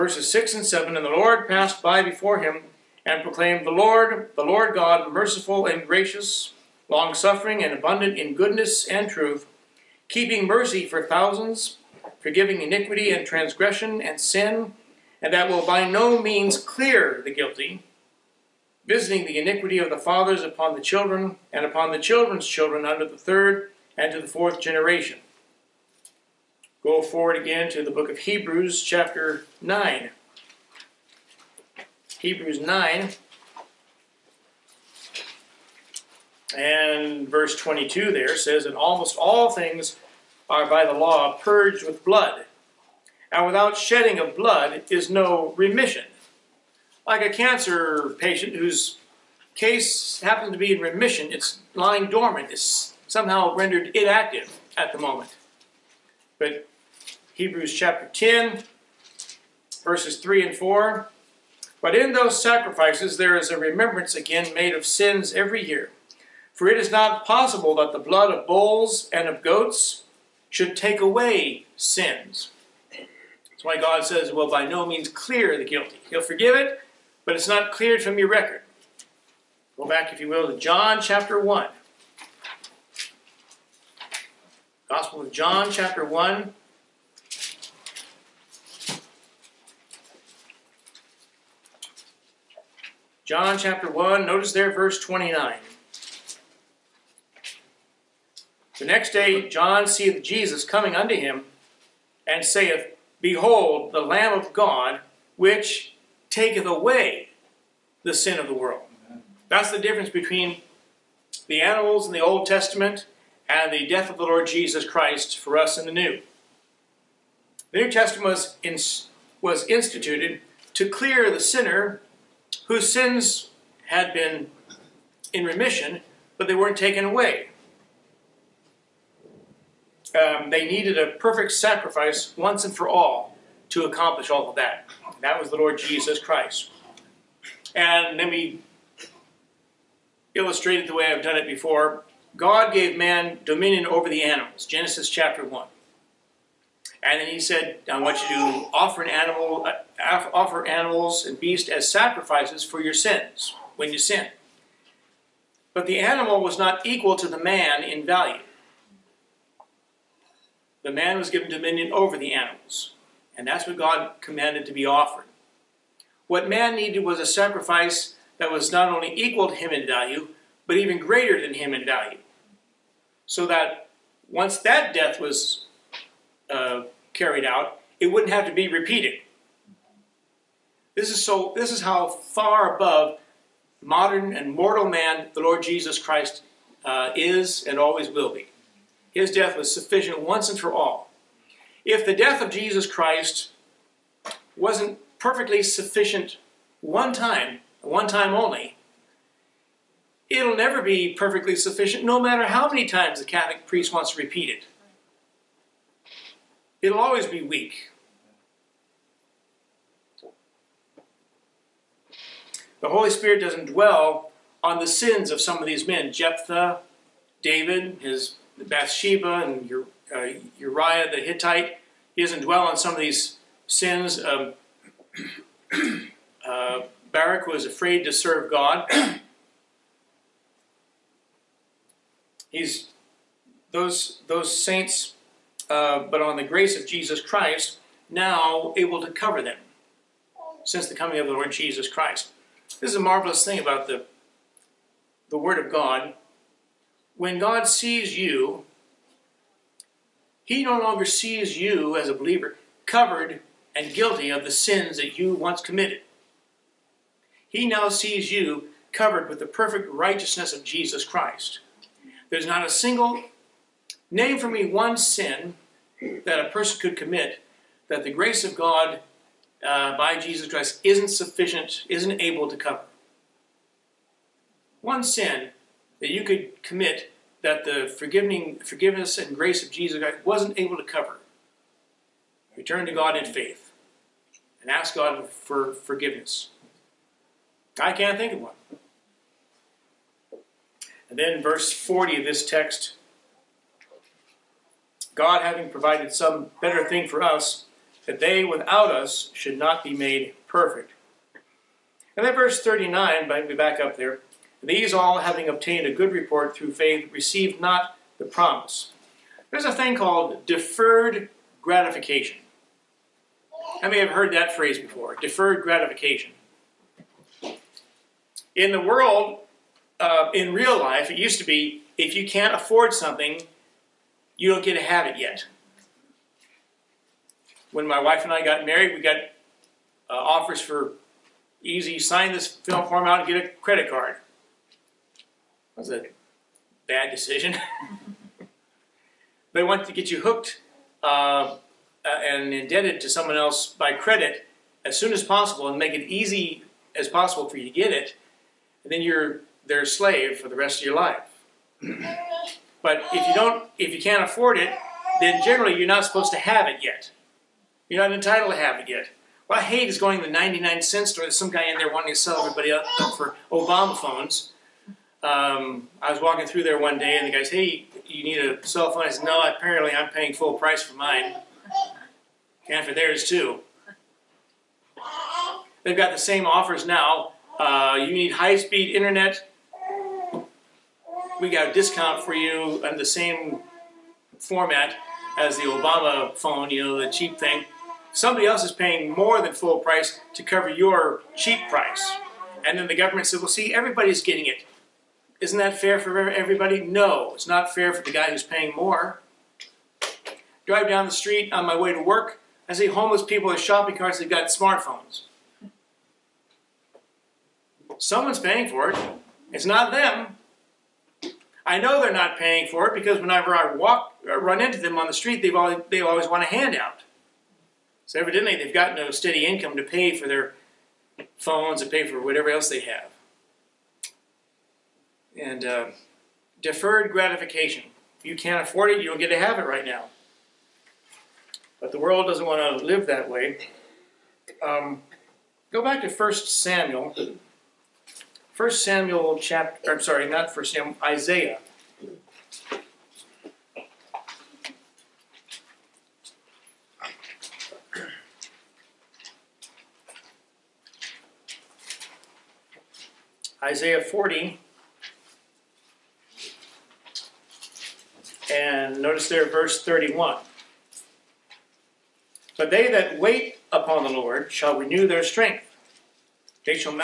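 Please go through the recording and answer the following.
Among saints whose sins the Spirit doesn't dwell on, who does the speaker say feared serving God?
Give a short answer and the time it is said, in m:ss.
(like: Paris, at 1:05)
Barak, at 3:47.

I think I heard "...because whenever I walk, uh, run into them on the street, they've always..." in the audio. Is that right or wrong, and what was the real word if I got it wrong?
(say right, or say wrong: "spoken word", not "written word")
right.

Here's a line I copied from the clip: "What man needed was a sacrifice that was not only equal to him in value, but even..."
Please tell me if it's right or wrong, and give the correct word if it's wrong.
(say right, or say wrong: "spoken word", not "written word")
right.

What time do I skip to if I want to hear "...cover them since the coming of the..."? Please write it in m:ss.
3:59.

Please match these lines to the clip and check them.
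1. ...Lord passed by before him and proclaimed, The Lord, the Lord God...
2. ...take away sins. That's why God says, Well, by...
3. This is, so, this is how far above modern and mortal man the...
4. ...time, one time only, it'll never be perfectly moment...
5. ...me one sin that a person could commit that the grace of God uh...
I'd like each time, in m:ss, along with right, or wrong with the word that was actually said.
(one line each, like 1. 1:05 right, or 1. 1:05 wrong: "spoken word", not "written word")
1. 0:01 right
2. 1:10 right
3. 3:00 right
4. 3:17 wrong: "sufficient", not "moment"
5. 4:24 right.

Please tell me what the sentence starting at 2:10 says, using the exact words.
Um, they needed a perfect sacrifice once and for all to accomplish all of that.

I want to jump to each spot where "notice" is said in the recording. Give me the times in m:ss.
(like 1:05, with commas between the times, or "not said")
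1:34, 7:39.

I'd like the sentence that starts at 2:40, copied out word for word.
The man was given dominion over the animals.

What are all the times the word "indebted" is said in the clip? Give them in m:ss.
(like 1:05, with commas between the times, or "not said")
5:42.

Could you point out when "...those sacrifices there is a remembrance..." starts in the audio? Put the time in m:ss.
1:02.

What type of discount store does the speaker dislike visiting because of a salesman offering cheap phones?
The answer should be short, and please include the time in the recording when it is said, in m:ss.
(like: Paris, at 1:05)
99 cent store, at 6:00.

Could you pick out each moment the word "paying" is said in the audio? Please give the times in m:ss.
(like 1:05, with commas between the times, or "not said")
6:10, 6:28, 6:38, 6:48, 6:52.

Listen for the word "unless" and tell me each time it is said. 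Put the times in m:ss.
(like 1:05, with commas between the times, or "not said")
not said.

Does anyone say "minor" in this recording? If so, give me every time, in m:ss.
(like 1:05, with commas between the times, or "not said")
not said.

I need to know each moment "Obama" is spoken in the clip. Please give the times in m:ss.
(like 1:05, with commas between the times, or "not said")
6:03, 6:25.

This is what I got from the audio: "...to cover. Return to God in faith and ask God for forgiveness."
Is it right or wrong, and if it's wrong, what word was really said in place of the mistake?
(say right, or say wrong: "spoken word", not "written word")
right.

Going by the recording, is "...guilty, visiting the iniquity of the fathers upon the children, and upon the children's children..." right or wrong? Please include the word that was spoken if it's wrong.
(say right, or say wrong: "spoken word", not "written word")
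right.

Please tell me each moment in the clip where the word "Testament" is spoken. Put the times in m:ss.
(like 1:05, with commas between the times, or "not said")
1:52, 1:57.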